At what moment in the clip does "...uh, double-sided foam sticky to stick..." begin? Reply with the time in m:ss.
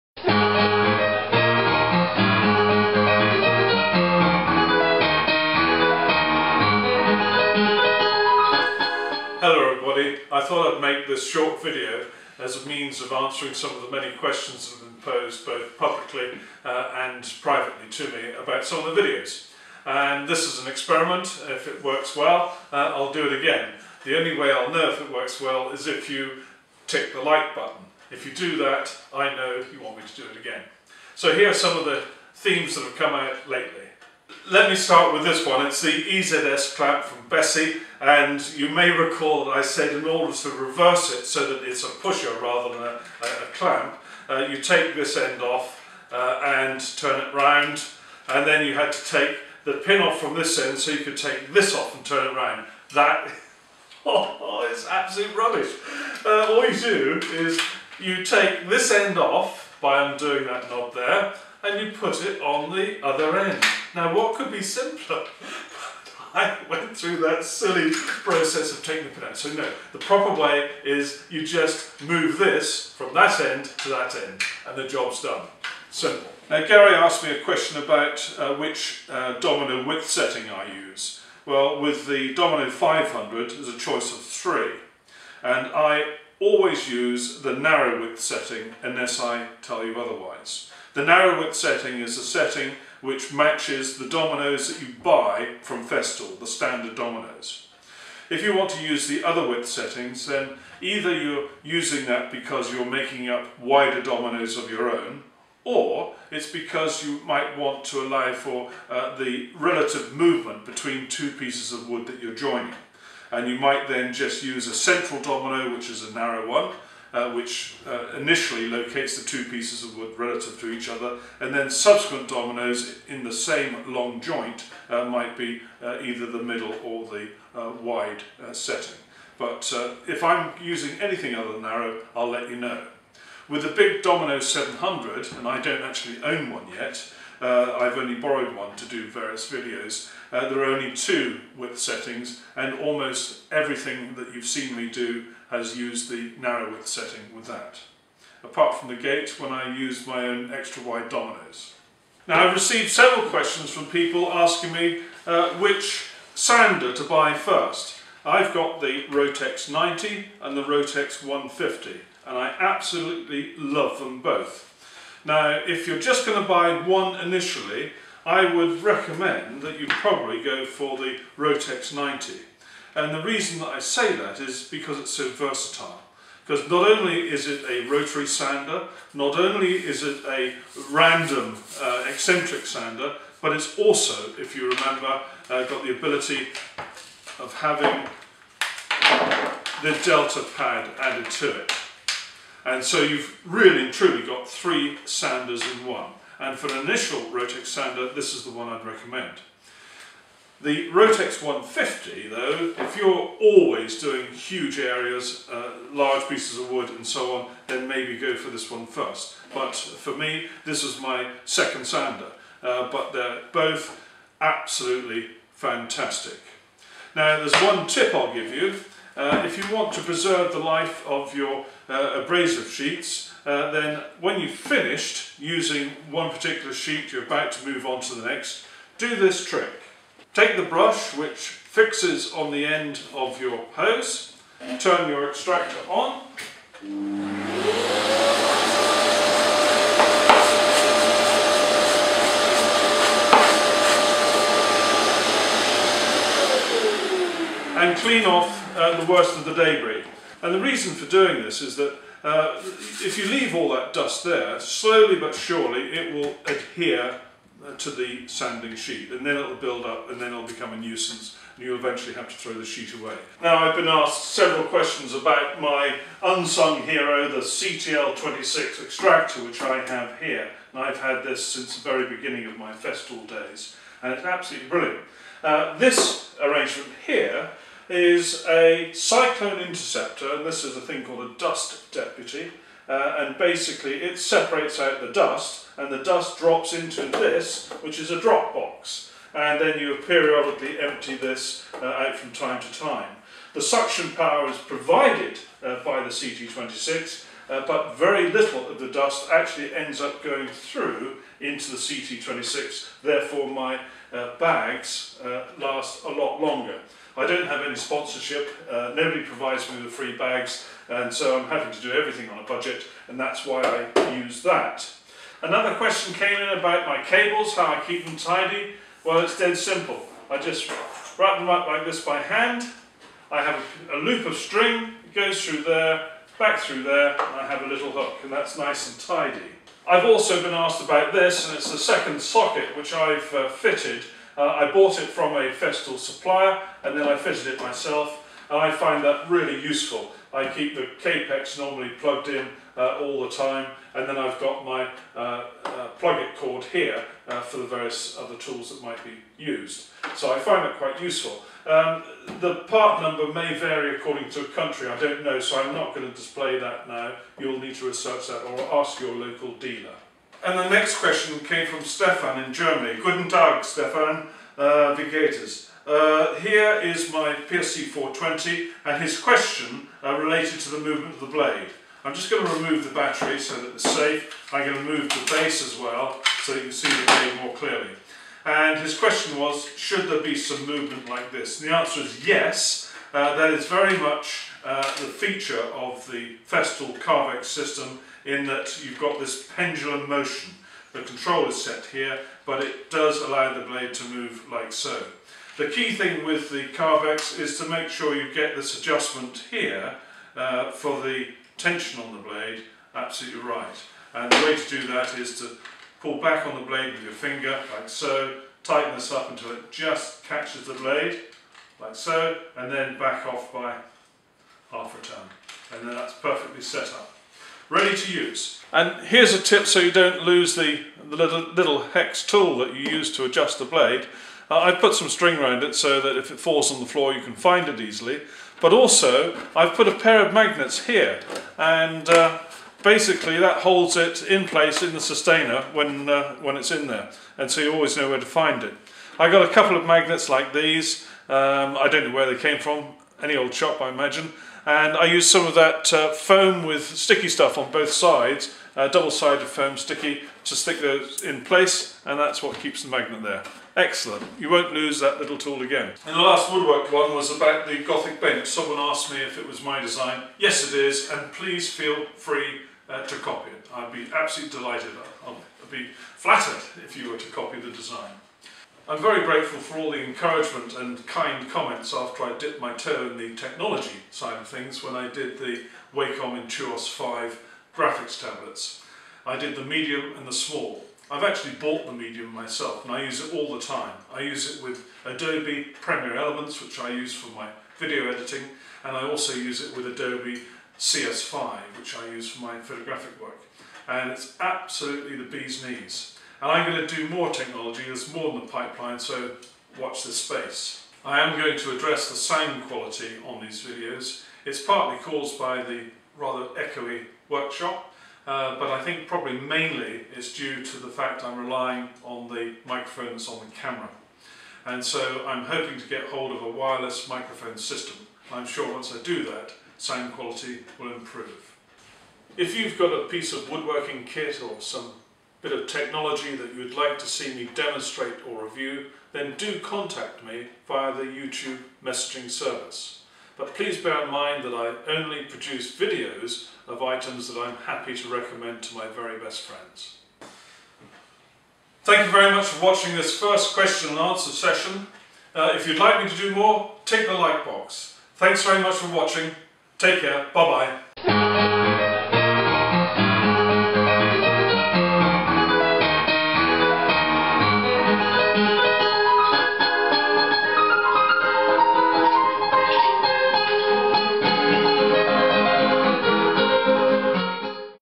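7:28.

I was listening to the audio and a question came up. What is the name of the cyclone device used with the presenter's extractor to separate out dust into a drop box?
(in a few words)
Dust Deputy.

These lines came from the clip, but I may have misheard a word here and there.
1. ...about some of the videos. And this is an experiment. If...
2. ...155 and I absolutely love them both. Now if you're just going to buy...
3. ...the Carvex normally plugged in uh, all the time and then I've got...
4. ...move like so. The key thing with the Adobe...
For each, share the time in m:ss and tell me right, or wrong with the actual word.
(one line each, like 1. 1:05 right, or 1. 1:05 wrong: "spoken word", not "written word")
1. 0:18 right
2. 2:41 wrong: "150", not "155"
3. 5:40 right
4. 6:34 wrong: "Carvex", not "Adobe".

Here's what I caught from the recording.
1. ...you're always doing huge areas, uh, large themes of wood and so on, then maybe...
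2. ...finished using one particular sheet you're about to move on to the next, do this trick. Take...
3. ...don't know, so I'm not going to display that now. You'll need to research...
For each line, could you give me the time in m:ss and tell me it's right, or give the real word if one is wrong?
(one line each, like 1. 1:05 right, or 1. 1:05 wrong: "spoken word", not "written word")
1. 3:22 wrong: "pieces", not "themes"
2. 3:44 right
3. 5:54 right.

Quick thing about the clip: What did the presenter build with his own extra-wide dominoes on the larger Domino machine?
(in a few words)
The gate.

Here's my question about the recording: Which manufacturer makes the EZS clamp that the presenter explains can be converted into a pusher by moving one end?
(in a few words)
Bessey.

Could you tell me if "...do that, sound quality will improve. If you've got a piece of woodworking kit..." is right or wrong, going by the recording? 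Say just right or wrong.
right.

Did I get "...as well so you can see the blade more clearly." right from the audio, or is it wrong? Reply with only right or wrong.
right.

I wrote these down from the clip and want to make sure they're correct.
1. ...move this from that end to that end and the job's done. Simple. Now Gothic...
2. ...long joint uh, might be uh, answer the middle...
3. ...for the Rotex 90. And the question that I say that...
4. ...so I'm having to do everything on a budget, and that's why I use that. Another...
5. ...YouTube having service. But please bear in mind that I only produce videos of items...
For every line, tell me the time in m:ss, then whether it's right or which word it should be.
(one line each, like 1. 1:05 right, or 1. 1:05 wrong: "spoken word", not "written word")
1. 1:12 wrong: "Gary", not "Gothic"
2. 2:03 wrong: "either", not "answer"
3. 2:50 wrong: "reason", not "question"
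4. 5:11 right
5. 8:51 wrong: "messaging", not "having".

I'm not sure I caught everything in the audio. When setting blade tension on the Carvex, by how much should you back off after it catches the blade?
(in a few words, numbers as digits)
Half a turn.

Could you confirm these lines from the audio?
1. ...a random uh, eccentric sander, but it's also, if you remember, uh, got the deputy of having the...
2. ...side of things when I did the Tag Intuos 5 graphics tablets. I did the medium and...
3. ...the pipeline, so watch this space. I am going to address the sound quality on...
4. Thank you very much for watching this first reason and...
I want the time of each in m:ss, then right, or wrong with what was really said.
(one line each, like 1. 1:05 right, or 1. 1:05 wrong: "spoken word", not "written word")
1. 3:00 wrong: "ability", not "deputy"
2. 7:54 wrong: "Wacom", not "Tag"
3. 8:18 right
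4. 9:01 wrong: "question", not "reason".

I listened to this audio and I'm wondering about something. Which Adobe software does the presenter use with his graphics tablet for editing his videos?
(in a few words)
Adobe Premiere Elements.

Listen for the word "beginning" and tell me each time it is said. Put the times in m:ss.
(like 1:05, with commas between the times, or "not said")
4:32.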